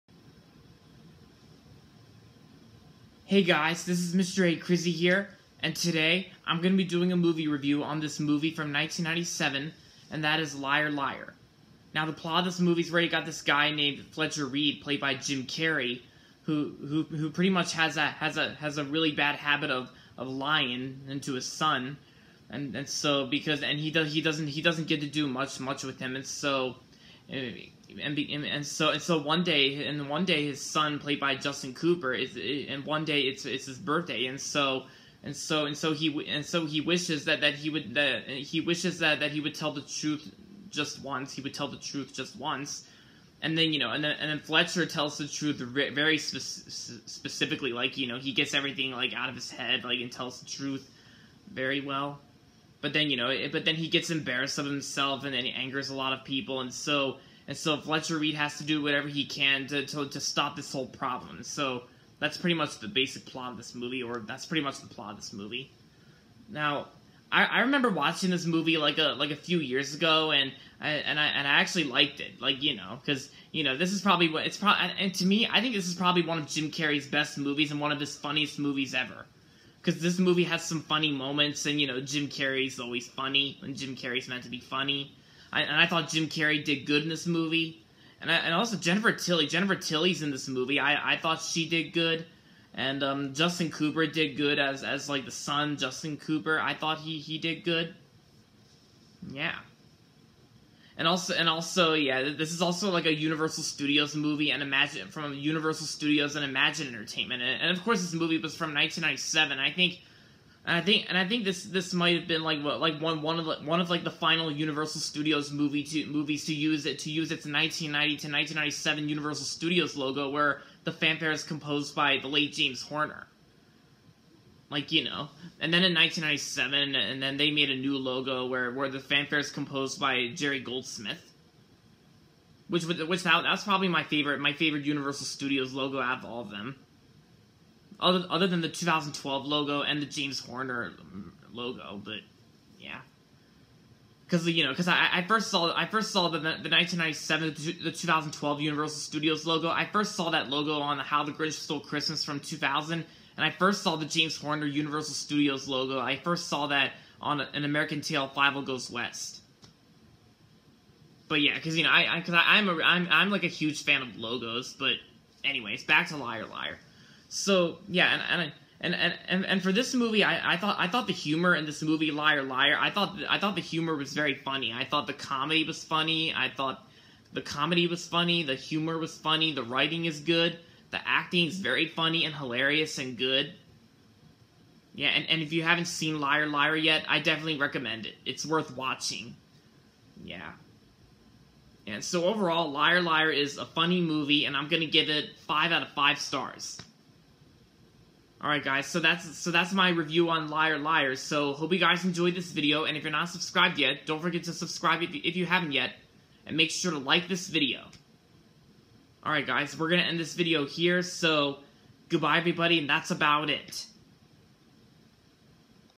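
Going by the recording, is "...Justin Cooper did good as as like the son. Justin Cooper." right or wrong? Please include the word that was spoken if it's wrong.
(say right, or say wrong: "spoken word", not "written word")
right.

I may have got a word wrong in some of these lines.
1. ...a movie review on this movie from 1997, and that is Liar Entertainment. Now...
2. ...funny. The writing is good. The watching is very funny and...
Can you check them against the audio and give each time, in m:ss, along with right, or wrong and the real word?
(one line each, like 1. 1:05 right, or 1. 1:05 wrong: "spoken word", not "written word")
1. 0:07 wrong: "Liar", not "Entertainment"
2. 2:59 wrong: "acting", not "watching".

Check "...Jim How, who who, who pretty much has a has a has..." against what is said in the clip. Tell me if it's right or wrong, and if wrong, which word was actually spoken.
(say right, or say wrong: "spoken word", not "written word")
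wrong: "Carrey", not "How".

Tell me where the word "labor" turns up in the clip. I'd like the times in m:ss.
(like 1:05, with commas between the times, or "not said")
not said.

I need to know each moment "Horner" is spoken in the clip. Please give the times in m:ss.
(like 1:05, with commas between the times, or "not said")
2:02, 2:20, 2:34.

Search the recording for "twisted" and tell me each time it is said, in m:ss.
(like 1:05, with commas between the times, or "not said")
not said.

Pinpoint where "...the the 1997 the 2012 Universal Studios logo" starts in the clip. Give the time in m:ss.
2:26.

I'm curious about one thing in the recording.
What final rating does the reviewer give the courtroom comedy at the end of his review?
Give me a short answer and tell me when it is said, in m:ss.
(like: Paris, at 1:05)
5 out of 5 stars, at 3:15.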